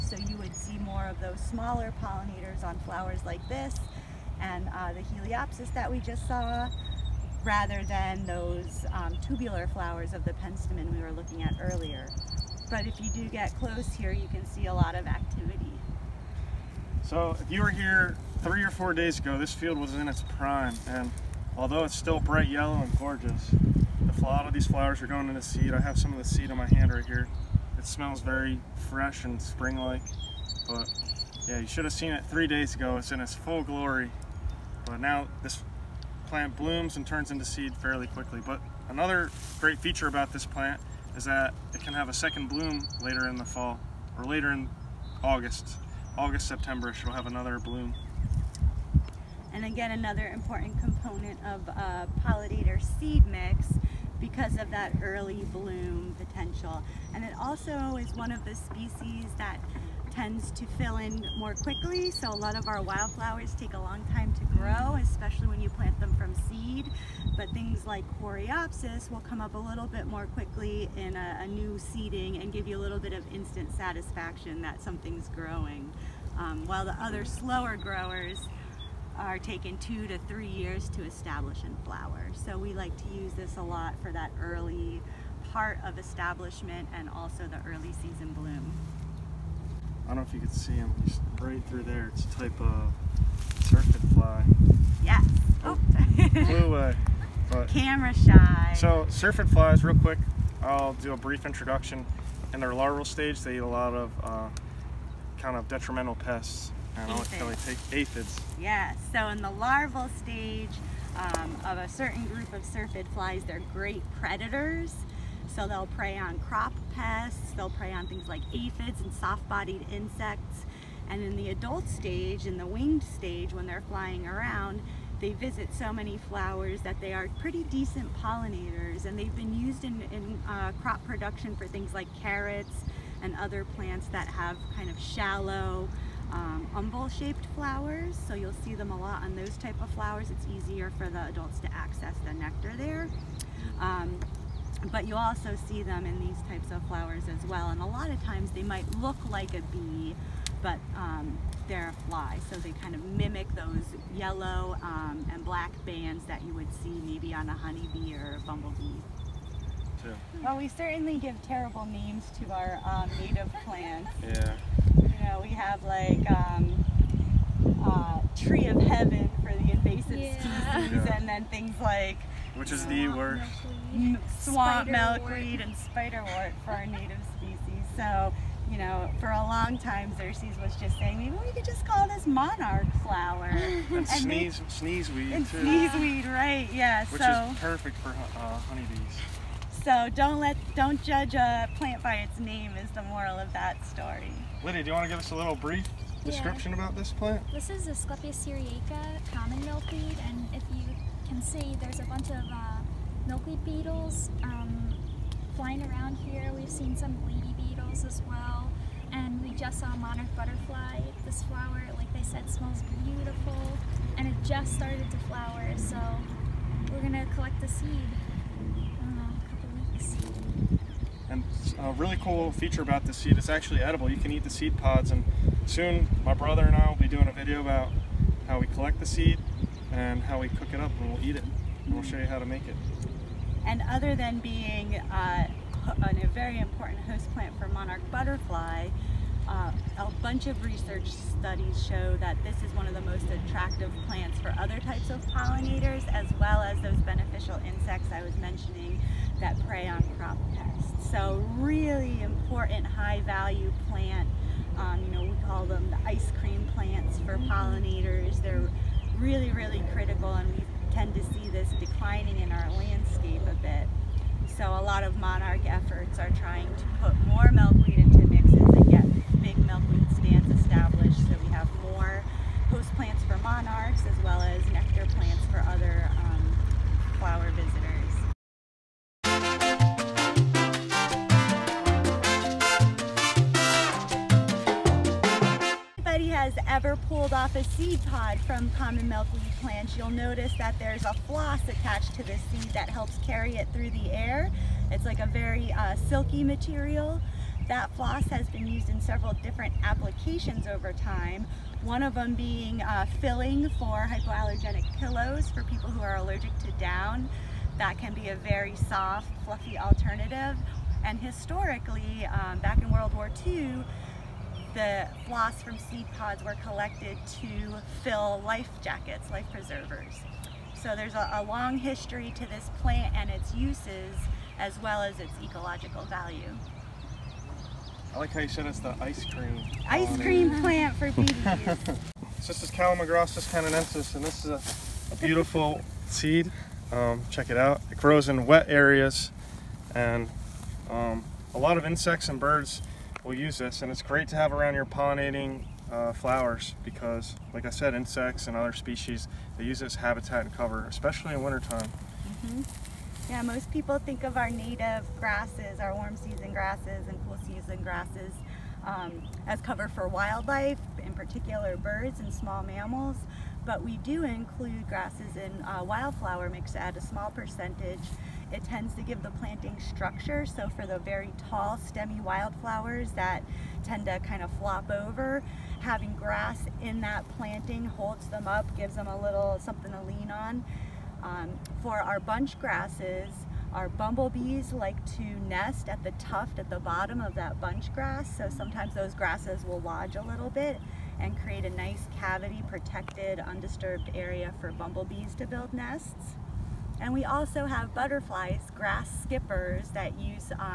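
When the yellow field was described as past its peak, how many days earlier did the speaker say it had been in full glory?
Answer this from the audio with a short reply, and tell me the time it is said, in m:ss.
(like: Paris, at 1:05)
3, at 0:32.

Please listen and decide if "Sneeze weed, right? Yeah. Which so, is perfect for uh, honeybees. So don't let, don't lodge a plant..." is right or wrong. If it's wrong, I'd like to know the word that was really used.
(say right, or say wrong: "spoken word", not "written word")
wrong: "judge", not "lodge".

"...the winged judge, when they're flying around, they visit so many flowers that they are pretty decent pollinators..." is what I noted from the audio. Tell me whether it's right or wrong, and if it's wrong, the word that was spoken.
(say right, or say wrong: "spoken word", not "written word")
wrong: "stage", not "judge".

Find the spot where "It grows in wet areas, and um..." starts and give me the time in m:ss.
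5:37.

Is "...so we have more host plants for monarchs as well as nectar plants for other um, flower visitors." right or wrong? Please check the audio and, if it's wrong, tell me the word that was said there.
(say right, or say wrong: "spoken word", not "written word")
right.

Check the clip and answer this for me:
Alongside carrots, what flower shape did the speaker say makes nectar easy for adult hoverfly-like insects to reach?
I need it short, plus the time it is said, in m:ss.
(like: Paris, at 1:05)
Umbel shaped, at 2:16.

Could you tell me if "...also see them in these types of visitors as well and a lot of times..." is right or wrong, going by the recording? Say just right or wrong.
wrong.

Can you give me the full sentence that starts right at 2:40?
Well, we certainly give terrible names to our um, native plants.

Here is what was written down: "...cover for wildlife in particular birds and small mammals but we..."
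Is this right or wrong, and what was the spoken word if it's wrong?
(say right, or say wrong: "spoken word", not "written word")
right.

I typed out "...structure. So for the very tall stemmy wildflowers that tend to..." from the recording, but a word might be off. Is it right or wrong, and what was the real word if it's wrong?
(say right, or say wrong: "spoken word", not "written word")
right.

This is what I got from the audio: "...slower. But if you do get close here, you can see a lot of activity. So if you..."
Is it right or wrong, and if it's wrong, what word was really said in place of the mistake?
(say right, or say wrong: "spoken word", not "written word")
wrong: "earlier", not "slower".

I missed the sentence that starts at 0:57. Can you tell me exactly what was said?
And it also is one of the species that tends to fill in more quickly.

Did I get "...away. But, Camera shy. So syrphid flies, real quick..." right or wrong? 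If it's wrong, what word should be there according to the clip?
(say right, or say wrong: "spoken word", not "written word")
right.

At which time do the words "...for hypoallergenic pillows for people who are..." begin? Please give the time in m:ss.
5:03.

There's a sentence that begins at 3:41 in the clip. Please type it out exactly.
a really cool feature about this seed, it's actually edible.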